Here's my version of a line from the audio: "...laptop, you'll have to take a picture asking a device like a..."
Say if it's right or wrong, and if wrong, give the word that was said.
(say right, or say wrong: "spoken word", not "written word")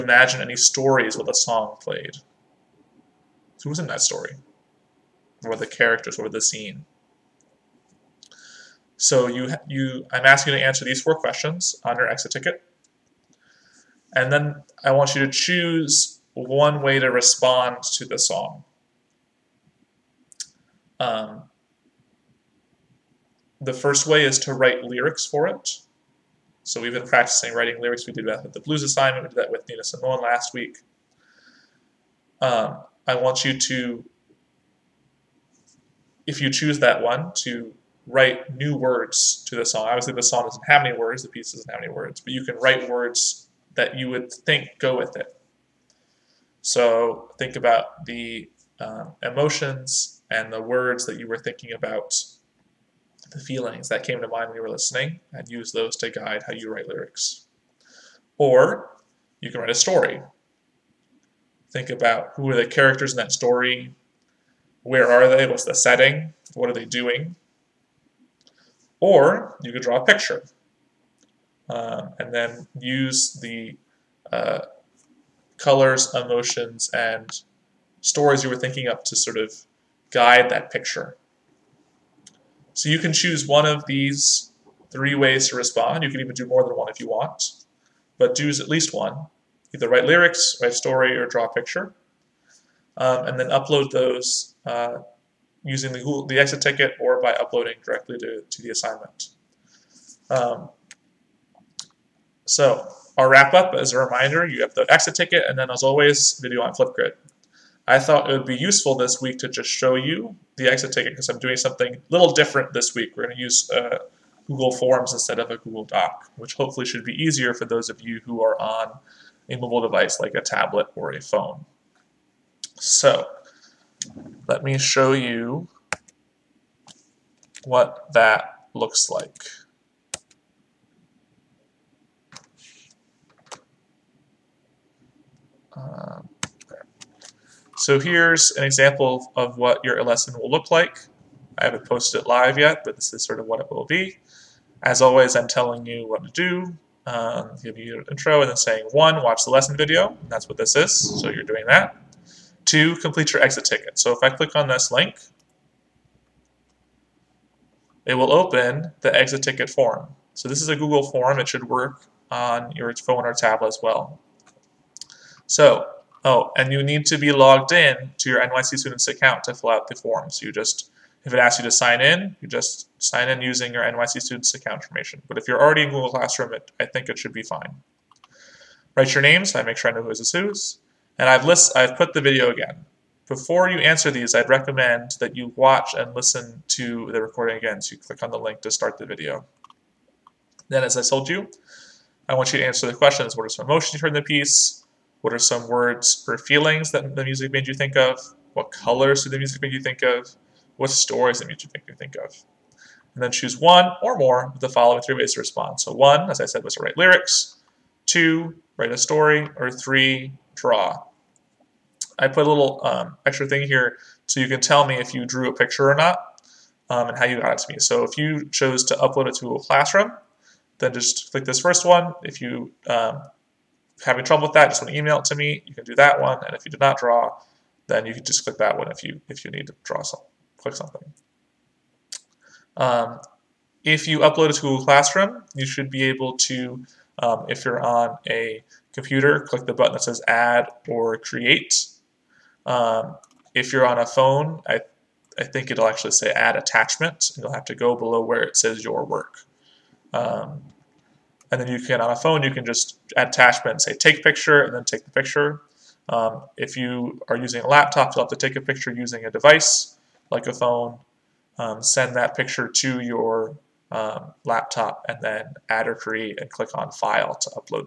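wrong: "using", not "asking".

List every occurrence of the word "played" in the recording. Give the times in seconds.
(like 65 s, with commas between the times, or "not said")
1 s.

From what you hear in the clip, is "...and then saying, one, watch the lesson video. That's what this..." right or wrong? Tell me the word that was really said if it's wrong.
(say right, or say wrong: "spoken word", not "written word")
right.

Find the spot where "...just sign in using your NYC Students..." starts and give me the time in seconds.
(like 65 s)
172 s.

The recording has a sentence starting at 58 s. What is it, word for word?
Or you can write a story.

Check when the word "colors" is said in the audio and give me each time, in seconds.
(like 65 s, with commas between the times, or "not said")
75 s, 198 s.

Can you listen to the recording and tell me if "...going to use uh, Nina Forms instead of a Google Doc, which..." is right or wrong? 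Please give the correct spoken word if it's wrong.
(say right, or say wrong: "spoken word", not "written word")
wrong: "Google", not "Nina".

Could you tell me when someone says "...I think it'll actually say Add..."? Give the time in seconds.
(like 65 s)
245 s.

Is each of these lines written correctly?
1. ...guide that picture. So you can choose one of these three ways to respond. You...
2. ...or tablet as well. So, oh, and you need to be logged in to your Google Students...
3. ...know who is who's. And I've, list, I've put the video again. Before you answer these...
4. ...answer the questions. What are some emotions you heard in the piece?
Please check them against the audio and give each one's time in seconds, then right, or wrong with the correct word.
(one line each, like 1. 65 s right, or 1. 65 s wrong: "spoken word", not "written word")
1. 80 s right
2. 163 s wrong: "NYC", not "Google"
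3. 179 s right
4. 192 s right.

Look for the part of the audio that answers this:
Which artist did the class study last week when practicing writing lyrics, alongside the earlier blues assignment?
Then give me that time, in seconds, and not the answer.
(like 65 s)
29 s.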